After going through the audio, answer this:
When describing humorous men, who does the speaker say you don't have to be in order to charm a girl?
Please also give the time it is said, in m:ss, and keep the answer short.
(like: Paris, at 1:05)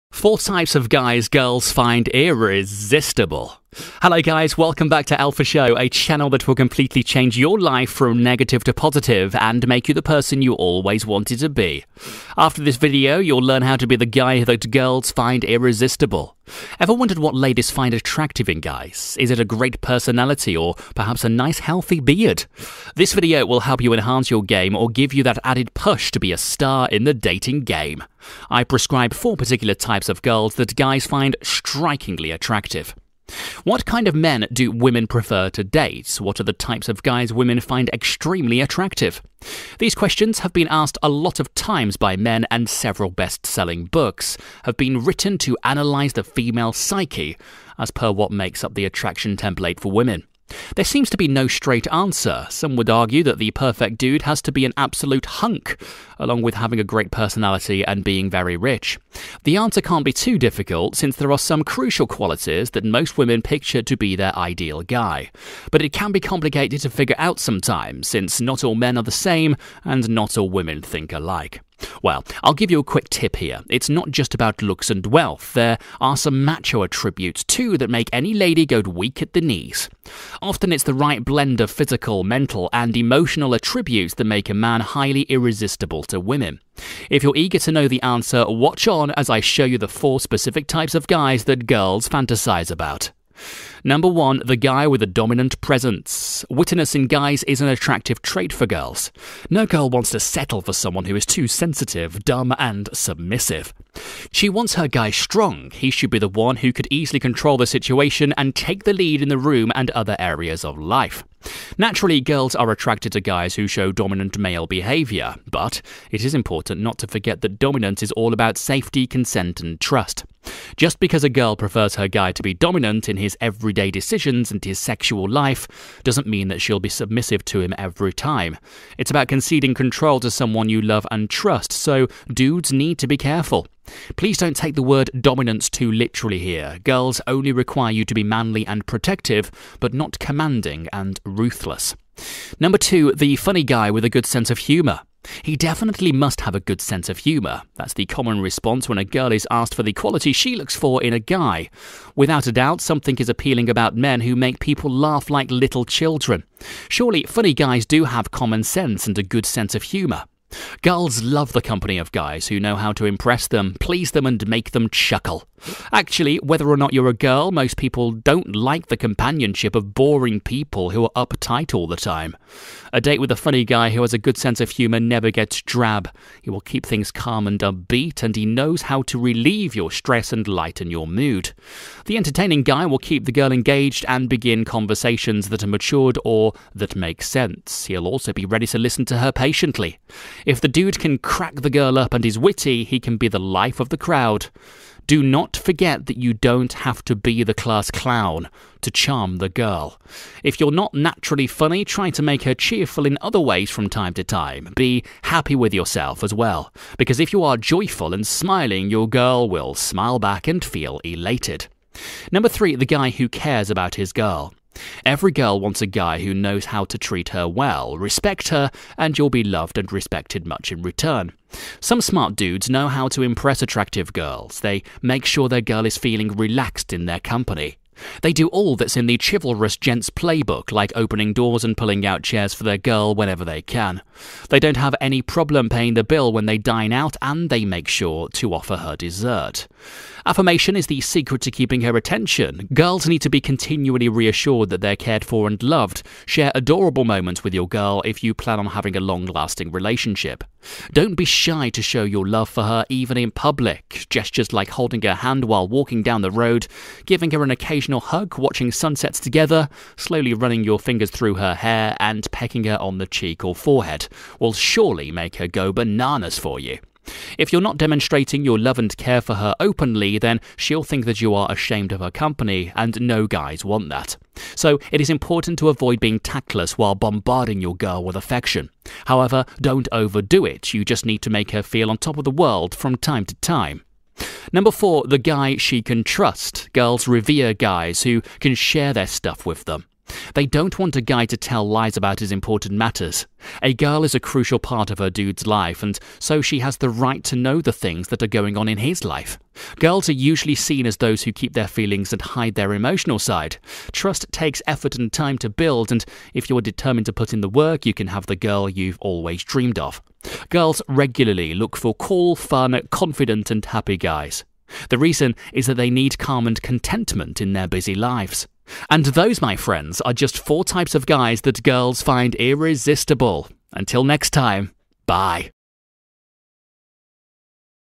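the class clown, at 3:17.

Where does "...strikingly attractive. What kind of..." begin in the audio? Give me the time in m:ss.
0:31.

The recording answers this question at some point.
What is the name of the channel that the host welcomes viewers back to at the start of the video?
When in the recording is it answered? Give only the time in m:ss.
0:05.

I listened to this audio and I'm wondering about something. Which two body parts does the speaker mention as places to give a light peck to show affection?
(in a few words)
cheek or forehead.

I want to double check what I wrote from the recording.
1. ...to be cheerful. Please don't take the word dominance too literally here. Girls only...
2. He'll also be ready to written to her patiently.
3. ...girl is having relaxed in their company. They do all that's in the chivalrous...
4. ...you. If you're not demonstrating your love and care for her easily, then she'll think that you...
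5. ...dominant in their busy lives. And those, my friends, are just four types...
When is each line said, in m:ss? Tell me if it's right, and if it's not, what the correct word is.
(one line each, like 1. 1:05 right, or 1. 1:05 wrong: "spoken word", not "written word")
1. 2:12 wrong: "careful", not "cheerful"
2. 3:07 wrong: "listen", not "written"
3. 3:45 wrong: "feeling", not "having"
4. 4:26 wrong: "openly", not "easily"
5. 5:16 wrong: "contentment", not "dominant".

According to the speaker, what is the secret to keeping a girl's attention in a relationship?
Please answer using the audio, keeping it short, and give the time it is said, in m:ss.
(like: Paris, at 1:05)
Affirmation, at 4:00.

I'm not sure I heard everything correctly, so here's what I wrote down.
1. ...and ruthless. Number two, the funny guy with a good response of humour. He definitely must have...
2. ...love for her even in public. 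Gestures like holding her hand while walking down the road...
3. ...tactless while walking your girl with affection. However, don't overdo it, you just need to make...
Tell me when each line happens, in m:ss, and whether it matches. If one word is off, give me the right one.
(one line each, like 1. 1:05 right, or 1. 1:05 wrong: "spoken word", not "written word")
1. 2:20 wrong: "sense", not "response"
2. 4:12 right
3. 4:36 wrong: "bombarding", not "walking".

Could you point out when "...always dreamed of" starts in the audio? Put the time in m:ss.
5:09.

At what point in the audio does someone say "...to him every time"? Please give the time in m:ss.
2:07.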